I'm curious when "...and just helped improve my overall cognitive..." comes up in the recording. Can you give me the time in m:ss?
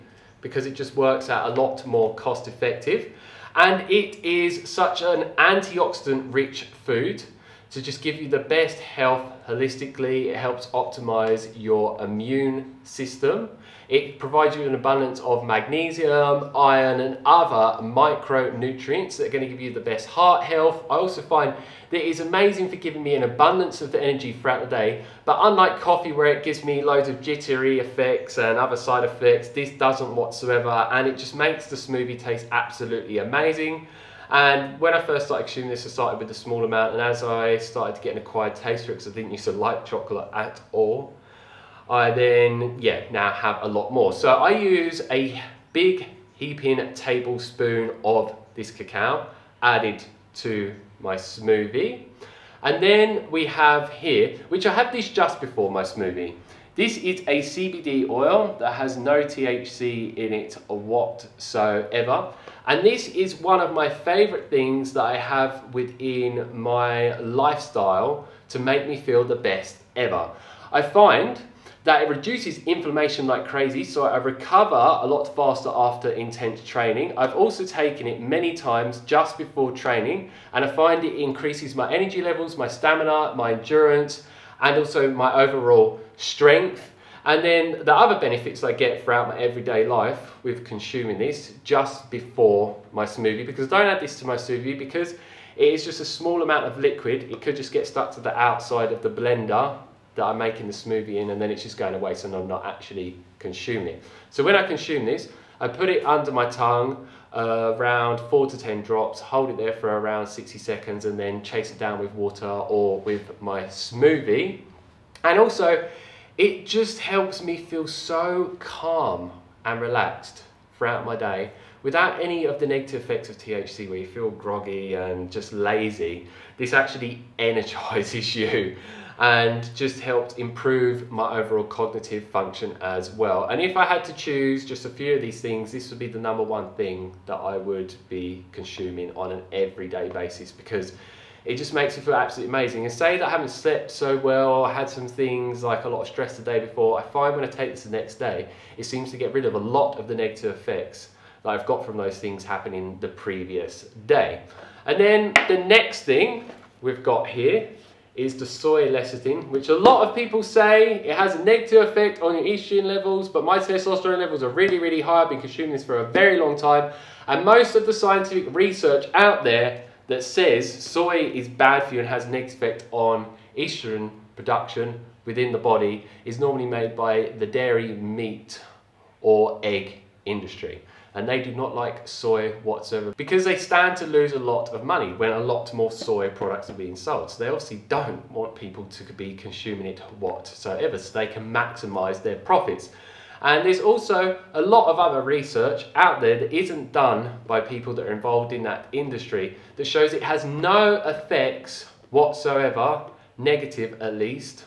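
2:09.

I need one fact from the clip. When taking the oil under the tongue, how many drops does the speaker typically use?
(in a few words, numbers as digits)
4 to 10 drops.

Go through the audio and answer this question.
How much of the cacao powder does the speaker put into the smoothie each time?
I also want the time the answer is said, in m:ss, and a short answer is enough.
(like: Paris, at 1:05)
a big heaping tablespoon, at 0:45.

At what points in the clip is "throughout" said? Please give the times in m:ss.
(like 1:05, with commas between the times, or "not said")
0:24, 1:29, 2:00.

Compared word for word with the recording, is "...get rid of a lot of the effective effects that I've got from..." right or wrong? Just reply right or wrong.
wrong.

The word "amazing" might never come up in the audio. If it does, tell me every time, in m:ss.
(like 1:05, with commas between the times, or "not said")
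0:22, 0:33, 2:22.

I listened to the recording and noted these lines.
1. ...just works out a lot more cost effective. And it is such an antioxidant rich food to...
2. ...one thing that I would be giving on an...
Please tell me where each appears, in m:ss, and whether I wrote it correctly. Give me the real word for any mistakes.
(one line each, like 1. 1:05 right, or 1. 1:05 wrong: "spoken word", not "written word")
1. 0:00 right
2. 2:16 wrong: "consuming", not "giving".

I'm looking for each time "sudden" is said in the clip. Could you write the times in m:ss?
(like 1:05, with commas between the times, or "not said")
not said.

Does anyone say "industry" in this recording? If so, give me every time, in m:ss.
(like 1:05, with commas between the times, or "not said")
3:00, 3:18.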